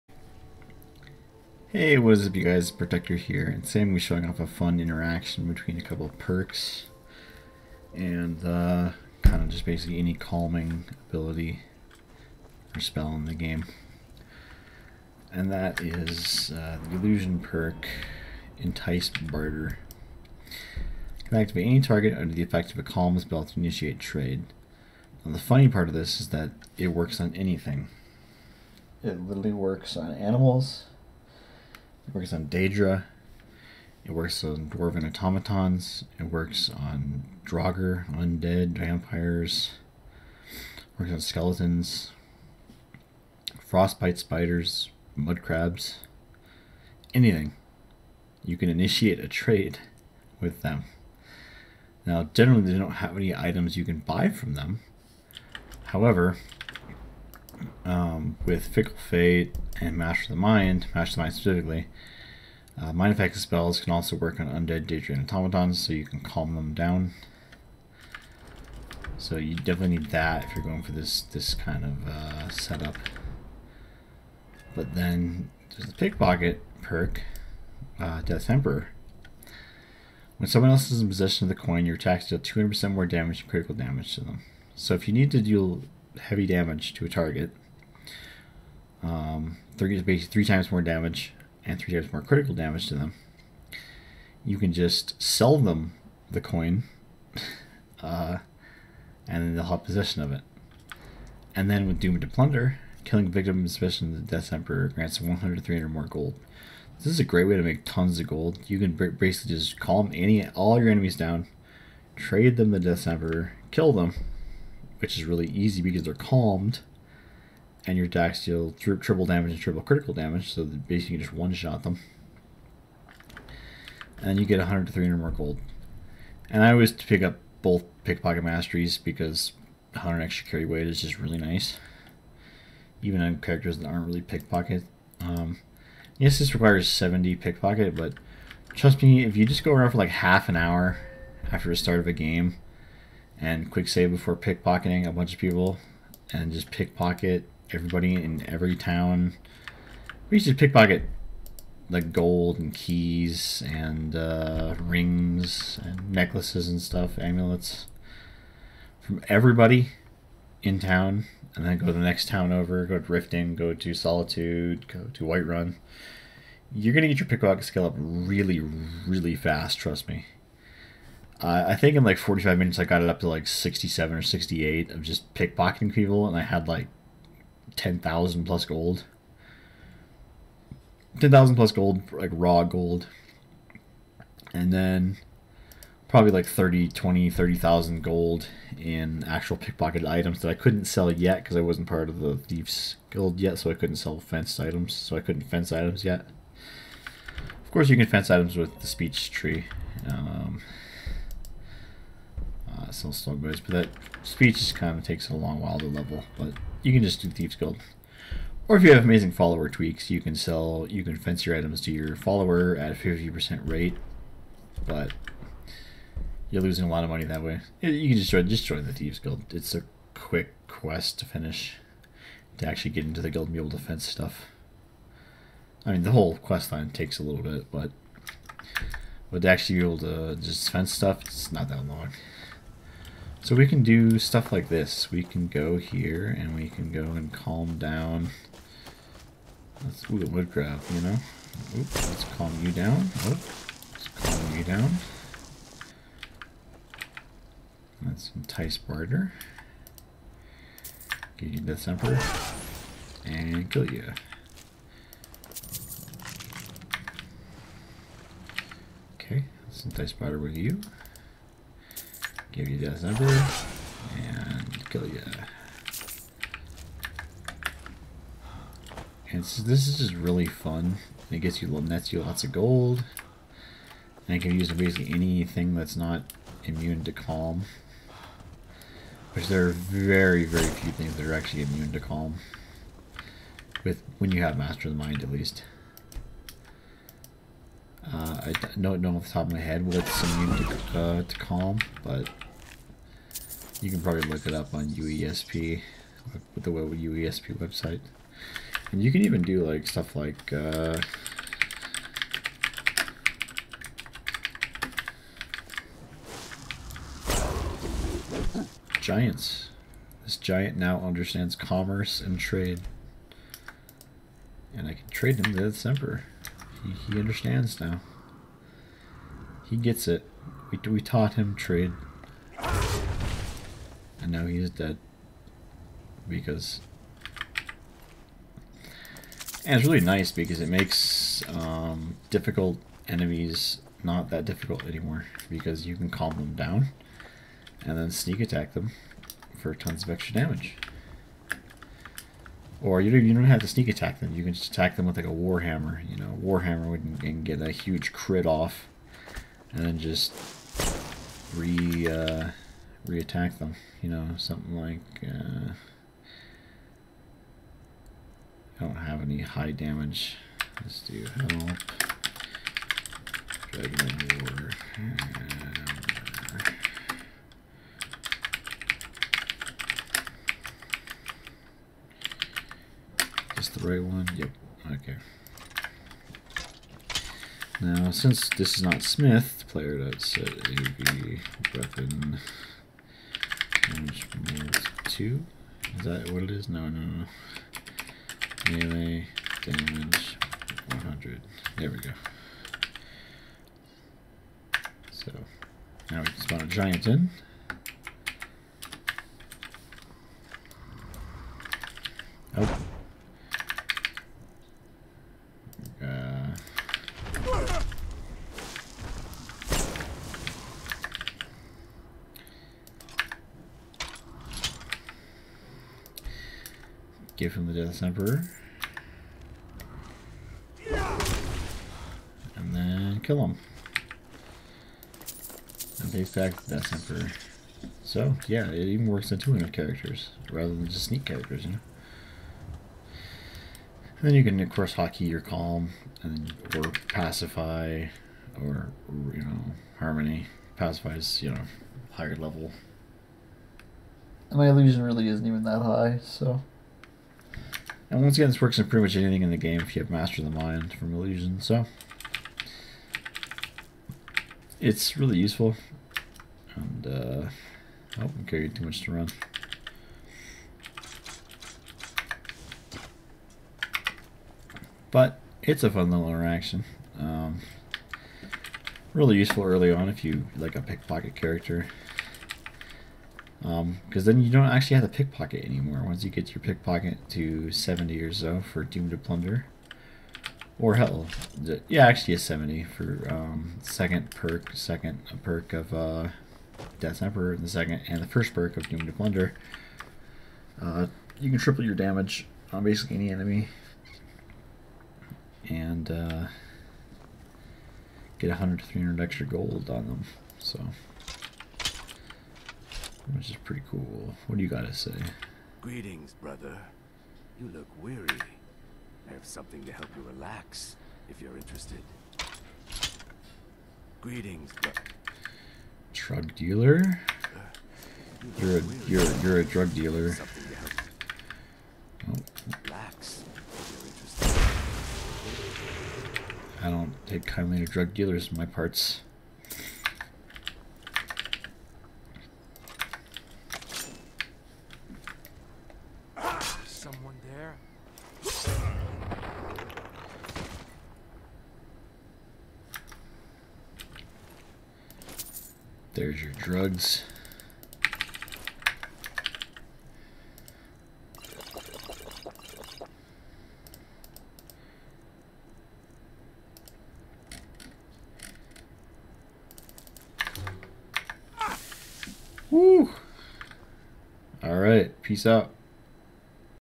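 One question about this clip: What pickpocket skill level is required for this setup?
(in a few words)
70.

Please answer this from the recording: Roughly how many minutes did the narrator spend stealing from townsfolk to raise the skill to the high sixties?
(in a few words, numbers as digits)
45.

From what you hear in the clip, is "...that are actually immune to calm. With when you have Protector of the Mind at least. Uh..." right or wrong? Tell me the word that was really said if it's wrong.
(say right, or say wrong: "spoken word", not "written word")
wrong: "Master", not "Protector".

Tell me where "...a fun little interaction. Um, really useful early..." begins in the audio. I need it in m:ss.
7:45.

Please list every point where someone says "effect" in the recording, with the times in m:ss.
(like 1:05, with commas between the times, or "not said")
0:22, 1:03.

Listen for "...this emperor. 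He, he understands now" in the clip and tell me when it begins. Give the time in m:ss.
5:15.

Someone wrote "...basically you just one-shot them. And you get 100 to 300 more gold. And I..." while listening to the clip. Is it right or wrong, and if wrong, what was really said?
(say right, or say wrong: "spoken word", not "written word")
right.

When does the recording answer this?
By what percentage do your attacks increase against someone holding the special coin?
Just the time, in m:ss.
1:22.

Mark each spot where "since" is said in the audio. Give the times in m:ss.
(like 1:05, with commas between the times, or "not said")
6:18.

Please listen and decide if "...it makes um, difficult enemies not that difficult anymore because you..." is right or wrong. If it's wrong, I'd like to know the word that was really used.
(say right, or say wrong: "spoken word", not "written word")
right.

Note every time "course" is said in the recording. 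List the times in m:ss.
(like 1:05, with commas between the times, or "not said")
3:17, 7:14.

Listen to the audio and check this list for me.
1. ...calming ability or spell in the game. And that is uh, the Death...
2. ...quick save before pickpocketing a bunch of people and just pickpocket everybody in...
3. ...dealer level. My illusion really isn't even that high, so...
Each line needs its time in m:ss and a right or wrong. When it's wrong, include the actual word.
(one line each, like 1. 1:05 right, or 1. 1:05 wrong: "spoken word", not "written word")
1. 0:10 wrong: "Illusion", not "Death"
2. 2:23 right
3. 7:22 wrong: "higher", not "dealer".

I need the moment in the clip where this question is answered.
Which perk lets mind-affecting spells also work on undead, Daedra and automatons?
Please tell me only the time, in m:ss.
1:00.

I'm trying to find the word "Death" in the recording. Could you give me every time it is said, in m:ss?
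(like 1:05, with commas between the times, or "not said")
1:18, 1:44, 1:52, 6:57, 7:06, 8:06.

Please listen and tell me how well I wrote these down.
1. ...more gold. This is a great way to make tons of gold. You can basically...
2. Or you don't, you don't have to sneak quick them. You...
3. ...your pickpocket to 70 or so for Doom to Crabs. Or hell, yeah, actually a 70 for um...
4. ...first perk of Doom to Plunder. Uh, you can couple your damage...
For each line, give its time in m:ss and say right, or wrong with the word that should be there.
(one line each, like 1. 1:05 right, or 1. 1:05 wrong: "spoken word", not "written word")
1. 1:45 right
2. 5:42 wrong: "attack", not "quick"
3. 7:56 wrong: "Plunder", not "Crabs"
4. 8:08 wrong: "triple", not "couple".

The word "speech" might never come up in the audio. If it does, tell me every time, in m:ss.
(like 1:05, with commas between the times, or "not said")
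3:18, 3:24.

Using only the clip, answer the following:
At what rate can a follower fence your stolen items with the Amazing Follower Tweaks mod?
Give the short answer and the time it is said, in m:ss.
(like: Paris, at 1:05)
50%, at 3:32.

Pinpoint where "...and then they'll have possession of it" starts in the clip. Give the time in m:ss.
1:39.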